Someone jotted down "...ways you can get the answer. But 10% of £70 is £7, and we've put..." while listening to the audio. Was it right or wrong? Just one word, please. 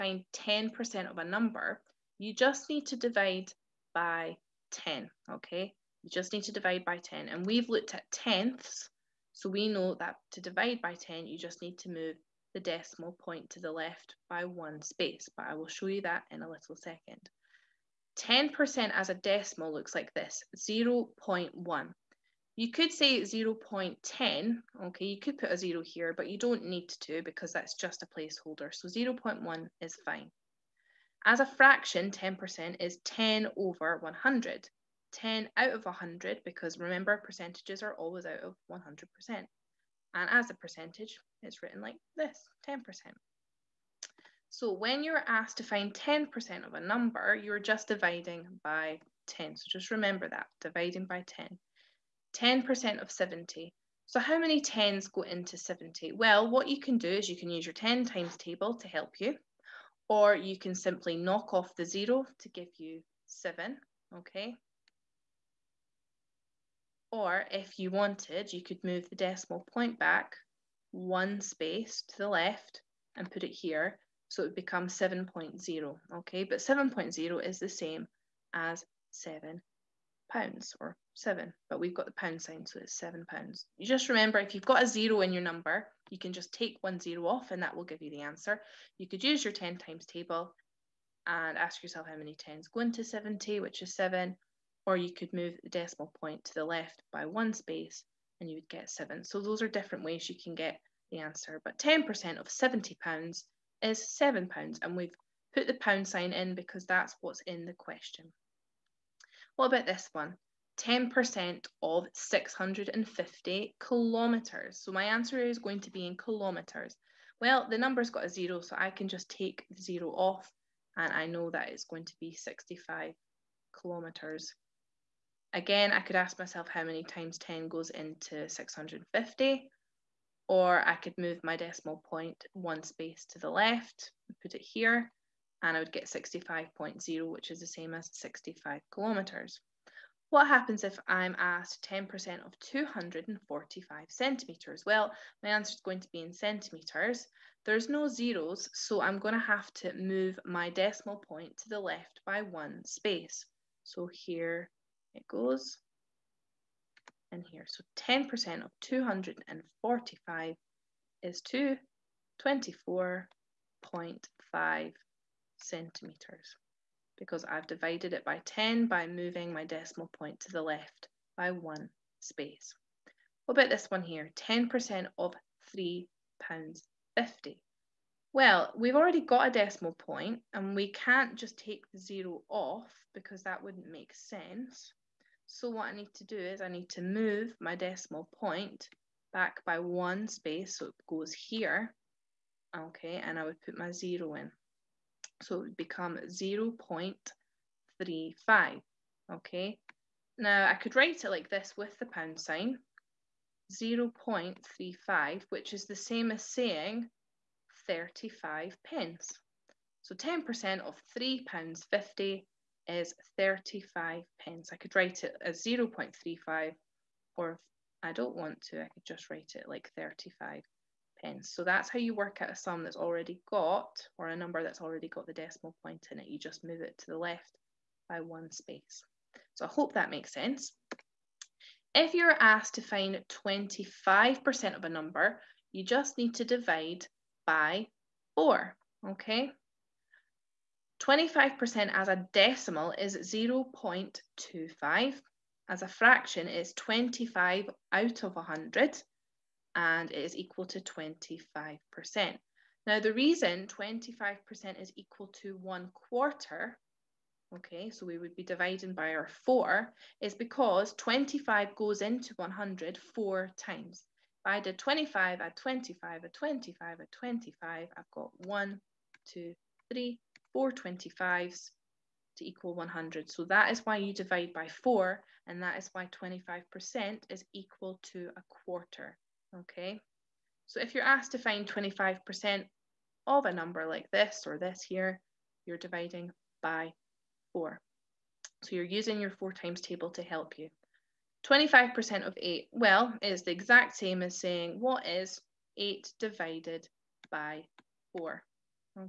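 right.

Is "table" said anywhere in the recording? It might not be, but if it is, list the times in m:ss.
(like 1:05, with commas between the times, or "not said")
0:58, 1:30, 4:49.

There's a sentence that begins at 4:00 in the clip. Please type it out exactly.
25% as a decimal is 0.25.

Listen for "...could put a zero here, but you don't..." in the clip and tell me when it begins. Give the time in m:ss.
0:25.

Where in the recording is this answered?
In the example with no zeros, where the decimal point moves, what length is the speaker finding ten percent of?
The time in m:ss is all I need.
2:22.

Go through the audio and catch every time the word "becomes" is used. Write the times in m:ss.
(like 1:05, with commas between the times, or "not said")
1:14, 3:15.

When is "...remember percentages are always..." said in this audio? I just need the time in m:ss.
0:36.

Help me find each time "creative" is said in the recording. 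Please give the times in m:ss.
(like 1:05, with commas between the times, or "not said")
not said.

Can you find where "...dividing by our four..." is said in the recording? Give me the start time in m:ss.
4:18.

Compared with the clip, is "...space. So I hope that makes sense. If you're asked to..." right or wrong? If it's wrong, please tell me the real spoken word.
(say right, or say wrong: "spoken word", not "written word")
right.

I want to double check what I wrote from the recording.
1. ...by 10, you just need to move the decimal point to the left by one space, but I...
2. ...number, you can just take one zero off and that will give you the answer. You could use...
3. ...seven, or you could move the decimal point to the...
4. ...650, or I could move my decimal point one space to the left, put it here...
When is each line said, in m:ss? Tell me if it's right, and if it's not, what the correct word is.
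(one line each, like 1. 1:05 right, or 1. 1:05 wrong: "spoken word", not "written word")
1. 0:10 right
2. 1:25 right
3. 1:33 right
4. 2:08 right.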